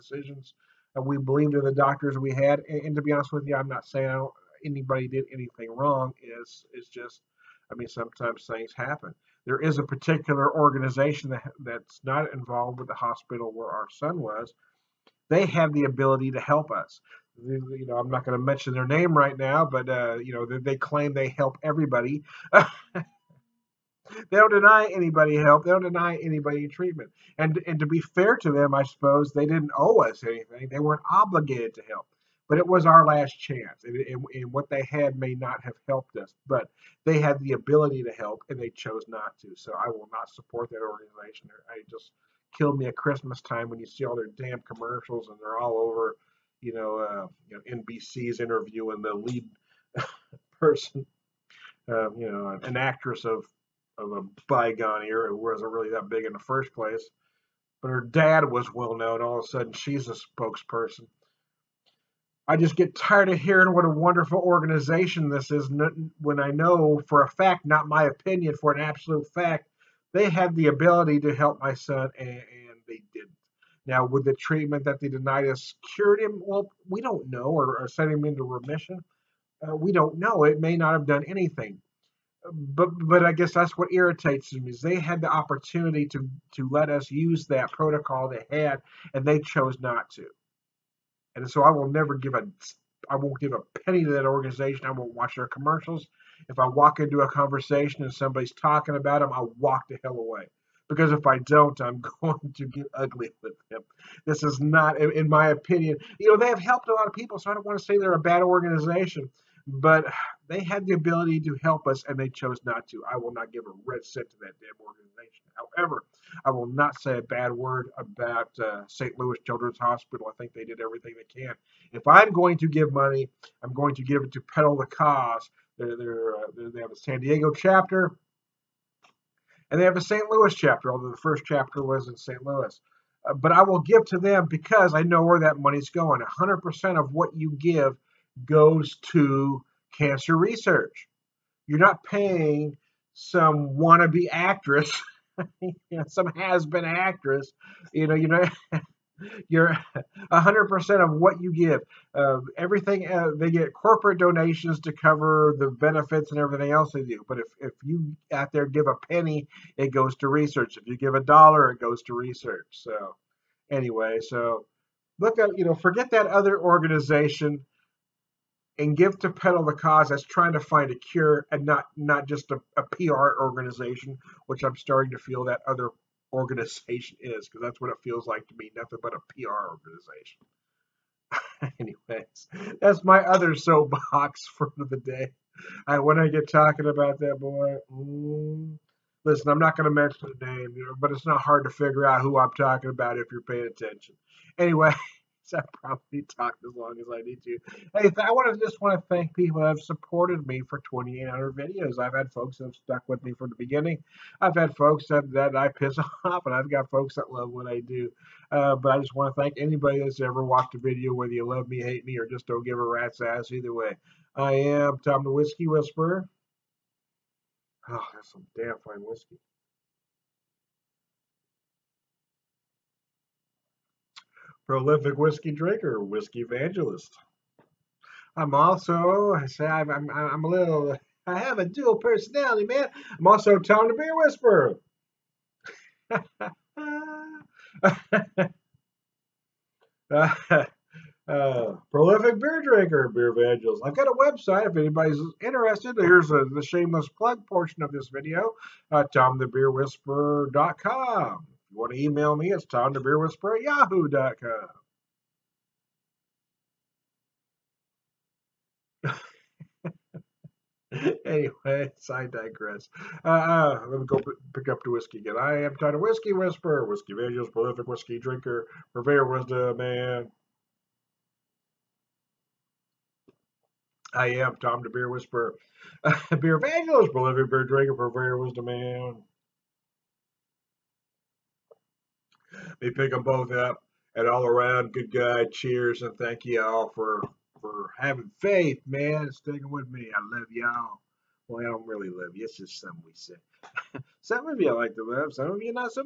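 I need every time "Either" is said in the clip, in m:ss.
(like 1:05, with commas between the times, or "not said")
3:33.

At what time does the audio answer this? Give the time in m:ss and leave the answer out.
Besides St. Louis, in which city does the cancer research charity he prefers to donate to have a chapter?
2:06.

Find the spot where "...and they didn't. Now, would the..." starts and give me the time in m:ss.
1:12.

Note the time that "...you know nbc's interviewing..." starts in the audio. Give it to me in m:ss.
0:47.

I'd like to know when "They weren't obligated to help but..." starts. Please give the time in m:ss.
0:30.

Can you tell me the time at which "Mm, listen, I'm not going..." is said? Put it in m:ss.
3:07.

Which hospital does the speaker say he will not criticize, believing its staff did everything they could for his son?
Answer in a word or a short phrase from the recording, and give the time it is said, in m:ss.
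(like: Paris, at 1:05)
St. Louis Children's Hospital, at 1:58.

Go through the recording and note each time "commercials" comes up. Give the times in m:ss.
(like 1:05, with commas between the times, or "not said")
0:44, 1:35.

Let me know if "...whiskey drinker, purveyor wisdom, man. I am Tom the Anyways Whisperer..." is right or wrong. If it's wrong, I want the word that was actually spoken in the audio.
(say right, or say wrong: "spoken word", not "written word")
wrong: "Beer", not "Anyways".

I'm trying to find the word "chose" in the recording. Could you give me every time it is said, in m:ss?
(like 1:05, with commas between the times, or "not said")
0:38, 1:29, 1:52.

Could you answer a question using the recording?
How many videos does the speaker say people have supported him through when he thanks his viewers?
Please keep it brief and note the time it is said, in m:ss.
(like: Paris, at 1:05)
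2,800, at 3:20.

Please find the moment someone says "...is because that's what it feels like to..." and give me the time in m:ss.
2:57.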